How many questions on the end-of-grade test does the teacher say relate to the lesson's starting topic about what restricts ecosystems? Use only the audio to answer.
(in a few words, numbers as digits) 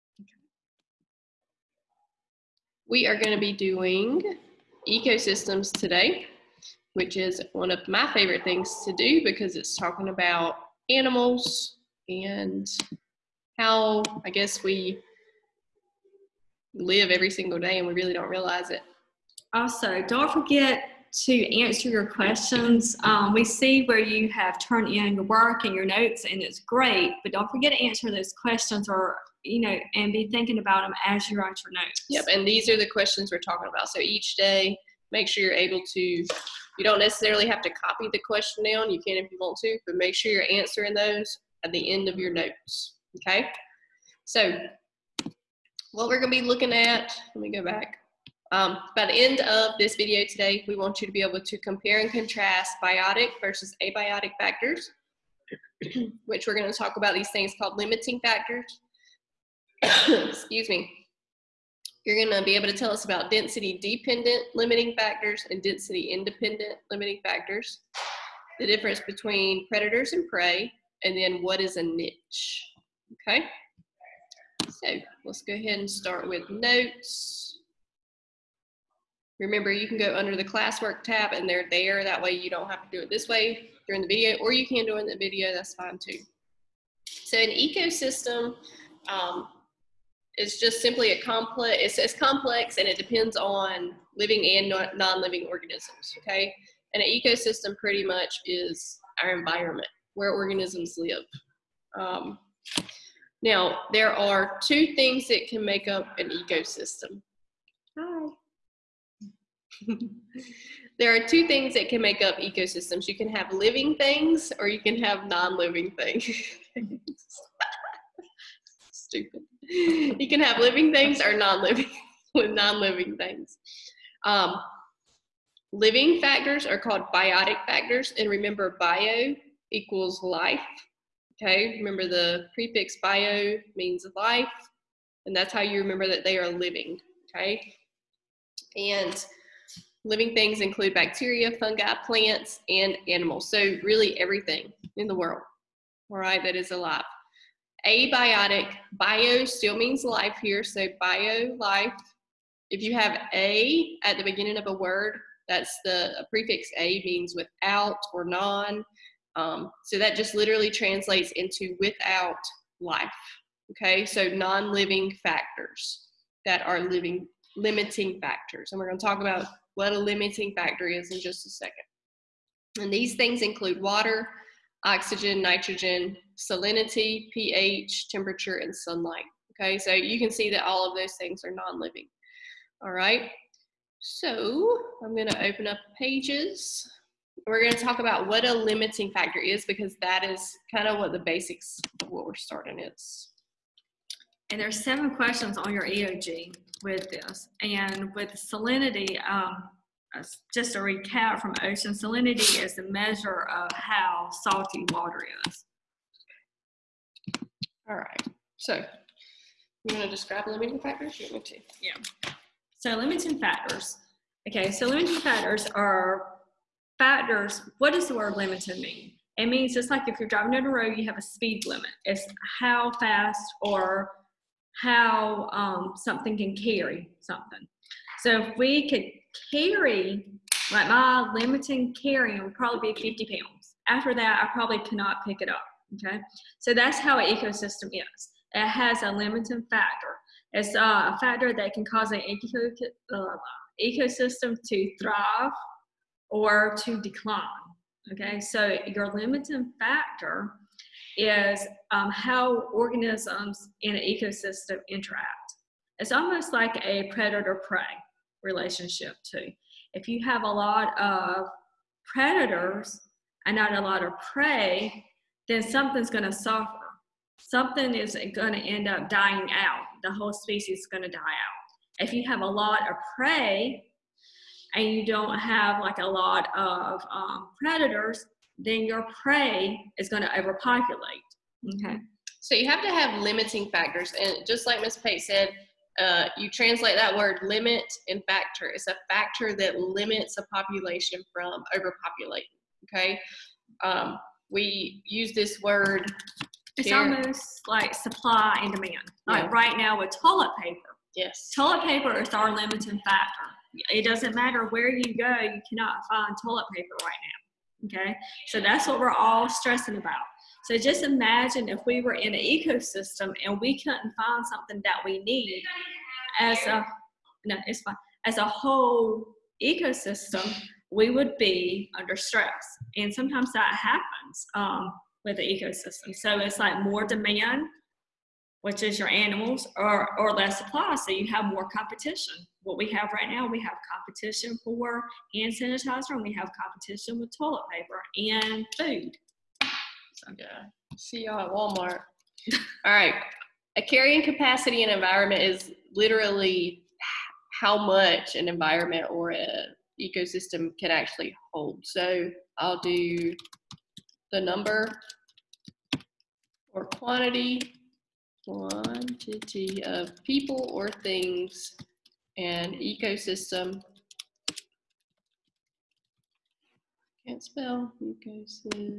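7.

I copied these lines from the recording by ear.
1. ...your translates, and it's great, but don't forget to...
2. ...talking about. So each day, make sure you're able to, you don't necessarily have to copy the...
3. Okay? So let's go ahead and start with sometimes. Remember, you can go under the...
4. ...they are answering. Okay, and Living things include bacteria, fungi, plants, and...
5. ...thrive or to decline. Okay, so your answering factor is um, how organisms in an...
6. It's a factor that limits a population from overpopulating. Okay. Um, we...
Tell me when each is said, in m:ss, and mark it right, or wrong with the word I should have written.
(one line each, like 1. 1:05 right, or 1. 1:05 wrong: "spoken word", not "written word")
1. 0:25 wrong: "notes", not "translates"
2. 0:33 right
3. 1:13 wrong: "notes", not "sometimes"
4. 2:16 wrong: "living", not "answering"
5. 4:05 wrong: "limiting", not "answering"
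6. 4:48 right.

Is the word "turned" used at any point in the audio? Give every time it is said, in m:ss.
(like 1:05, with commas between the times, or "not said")
0:24.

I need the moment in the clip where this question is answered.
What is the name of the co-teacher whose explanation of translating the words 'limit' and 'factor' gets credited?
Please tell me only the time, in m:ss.
4:44.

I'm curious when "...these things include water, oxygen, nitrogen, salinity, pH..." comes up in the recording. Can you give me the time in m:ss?
2:52.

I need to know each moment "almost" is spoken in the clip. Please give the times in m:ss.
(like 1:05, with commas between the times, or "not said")
4:16, 4:56.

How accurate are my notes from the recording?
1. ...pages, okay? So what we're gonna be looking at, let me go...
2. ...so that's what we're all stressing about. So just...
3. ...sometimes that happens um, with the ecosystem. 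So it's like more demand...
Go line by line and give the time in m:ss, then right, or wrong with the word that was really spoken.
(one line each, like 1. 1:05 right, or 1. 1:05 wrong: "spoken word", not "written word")
1. 0:42 wrong: "notes", not "pages"
2. 5:08 right
3. 5:23 right.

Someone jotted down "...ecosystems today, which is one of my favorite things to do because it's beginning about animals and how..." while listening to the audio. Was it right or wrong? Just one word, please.
wrong.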